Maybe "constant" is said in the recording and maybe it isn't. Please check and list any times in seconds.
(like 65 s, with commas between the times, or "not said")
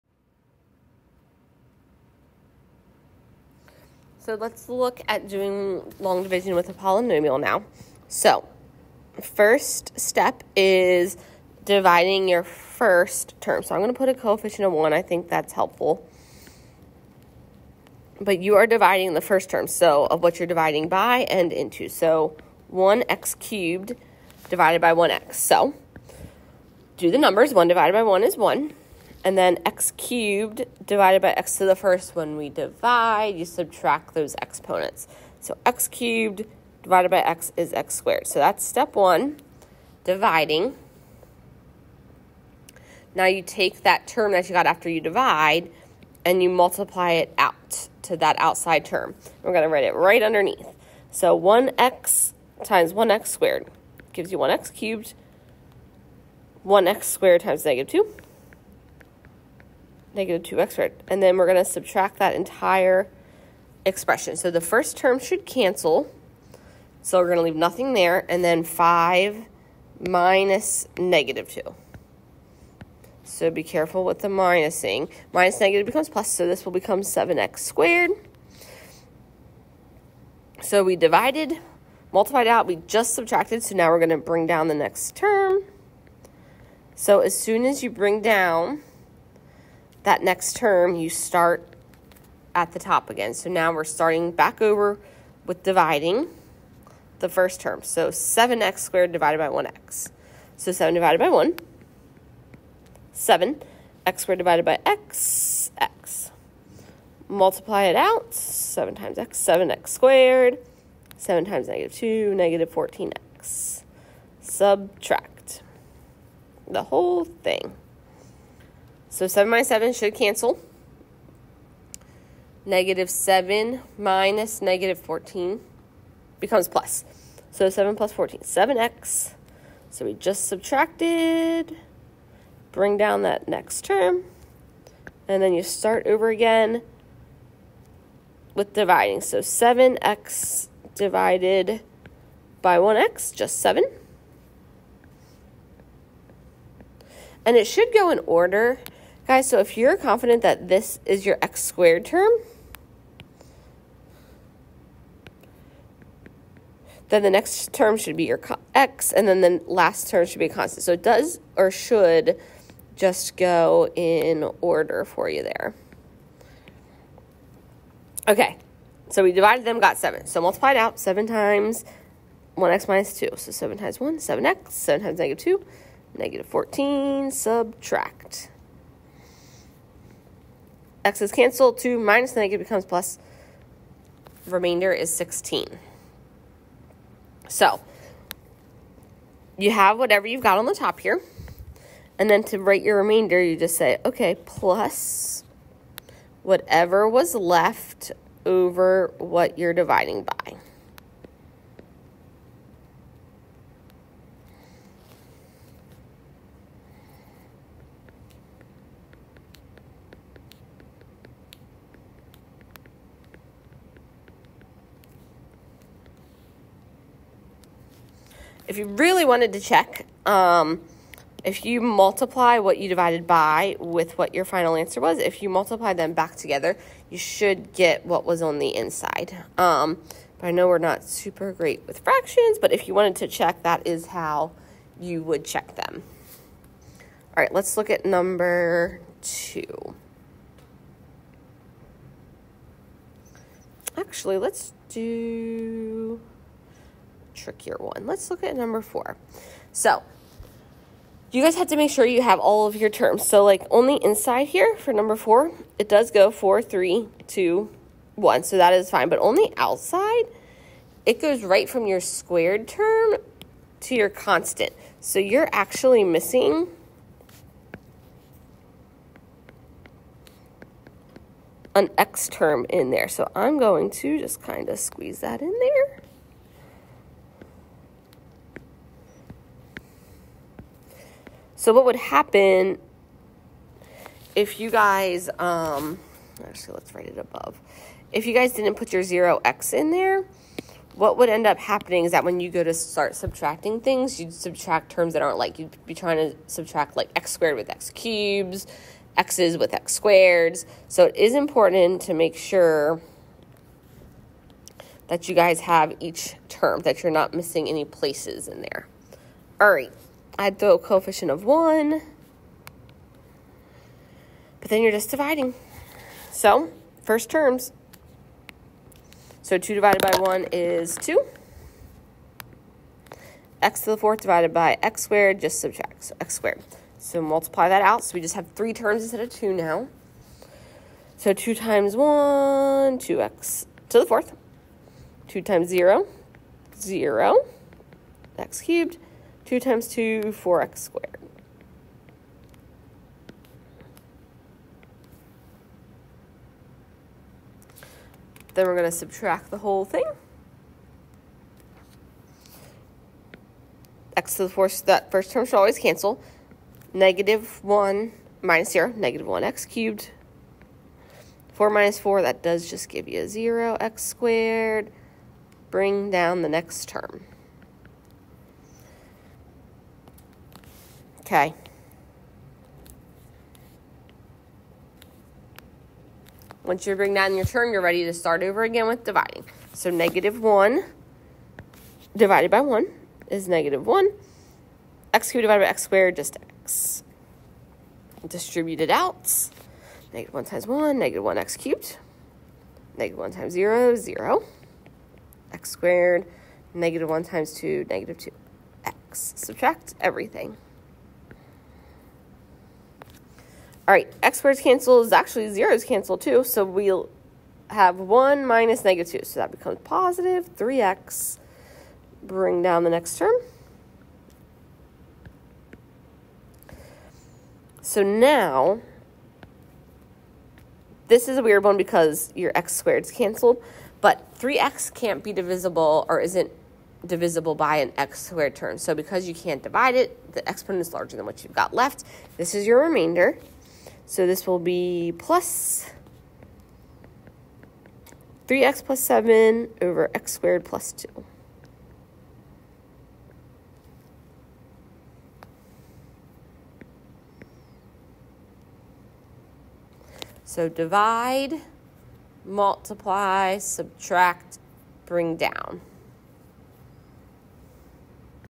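160 s, 264 s.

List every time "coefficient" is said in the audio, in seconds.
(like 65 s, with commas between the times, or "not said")
14 s, 310 s.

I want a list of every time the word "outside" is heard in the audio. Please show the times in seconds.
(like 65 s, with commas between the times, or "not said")
48 s, 259 s.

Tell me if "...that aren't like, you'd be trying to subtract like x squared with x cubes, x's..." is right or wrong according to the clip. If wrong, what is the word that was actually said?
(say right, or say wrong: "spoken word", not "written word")
right.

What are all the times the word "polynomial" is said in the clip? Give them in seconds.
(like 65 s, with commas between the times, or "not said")
6 s.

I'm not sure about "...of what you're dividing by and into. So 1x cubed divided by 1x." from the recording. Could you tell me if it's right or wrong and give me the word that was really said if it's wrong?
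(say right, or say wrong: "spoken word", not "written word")
right.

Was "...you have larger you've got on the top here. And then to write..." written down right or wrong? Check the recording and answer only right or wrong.
wrong.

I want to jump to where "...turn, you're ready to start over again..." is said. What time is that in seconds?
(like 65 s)
377 s.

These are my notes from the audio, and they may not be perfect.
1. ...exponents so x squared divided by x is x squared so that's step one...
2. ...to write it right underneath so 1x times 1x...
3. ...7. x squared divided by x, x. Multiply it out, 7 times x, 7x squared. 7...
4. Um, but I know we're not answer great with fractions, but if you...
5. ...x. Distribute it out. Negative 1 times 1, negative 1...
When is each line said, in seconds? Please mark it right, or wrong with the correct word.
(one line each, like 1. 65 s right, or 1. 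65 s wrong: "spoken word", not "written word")
1. 34 s wrong: "cubed", not "squared"
2. 49 s right
3. 103 s right
4. 229 s wrong: "super", not "answer"
5. 386 s right.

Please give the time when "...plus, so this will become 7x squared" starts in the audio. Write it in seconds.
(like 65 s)
76 s.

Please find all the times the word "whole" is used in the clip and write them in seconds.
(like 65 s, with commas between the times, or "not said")
116 s, 349 s.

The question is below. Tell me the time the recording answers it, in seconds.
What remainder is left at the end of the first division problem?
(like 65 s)
184 s.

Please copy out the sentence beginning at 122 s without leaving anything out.
Negative 7 minus negative 14 becomes plus.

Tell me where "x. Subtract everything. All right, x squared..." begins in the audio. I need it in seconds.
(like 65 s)
398 s.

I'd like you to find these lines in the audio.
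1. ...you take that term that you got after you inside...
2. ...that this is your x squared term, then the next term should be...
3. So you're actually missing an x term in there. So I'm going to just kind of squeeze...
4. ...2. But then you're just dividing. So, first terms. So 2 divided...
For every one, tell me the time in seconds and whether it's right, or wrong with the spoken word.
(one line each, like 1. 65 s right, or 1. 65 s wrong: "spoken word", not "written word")
1. 43 s wrong: "divide", not "inside"
2. 150 s right
3. 264 s right
4. 311 s wrong: "1", not "2".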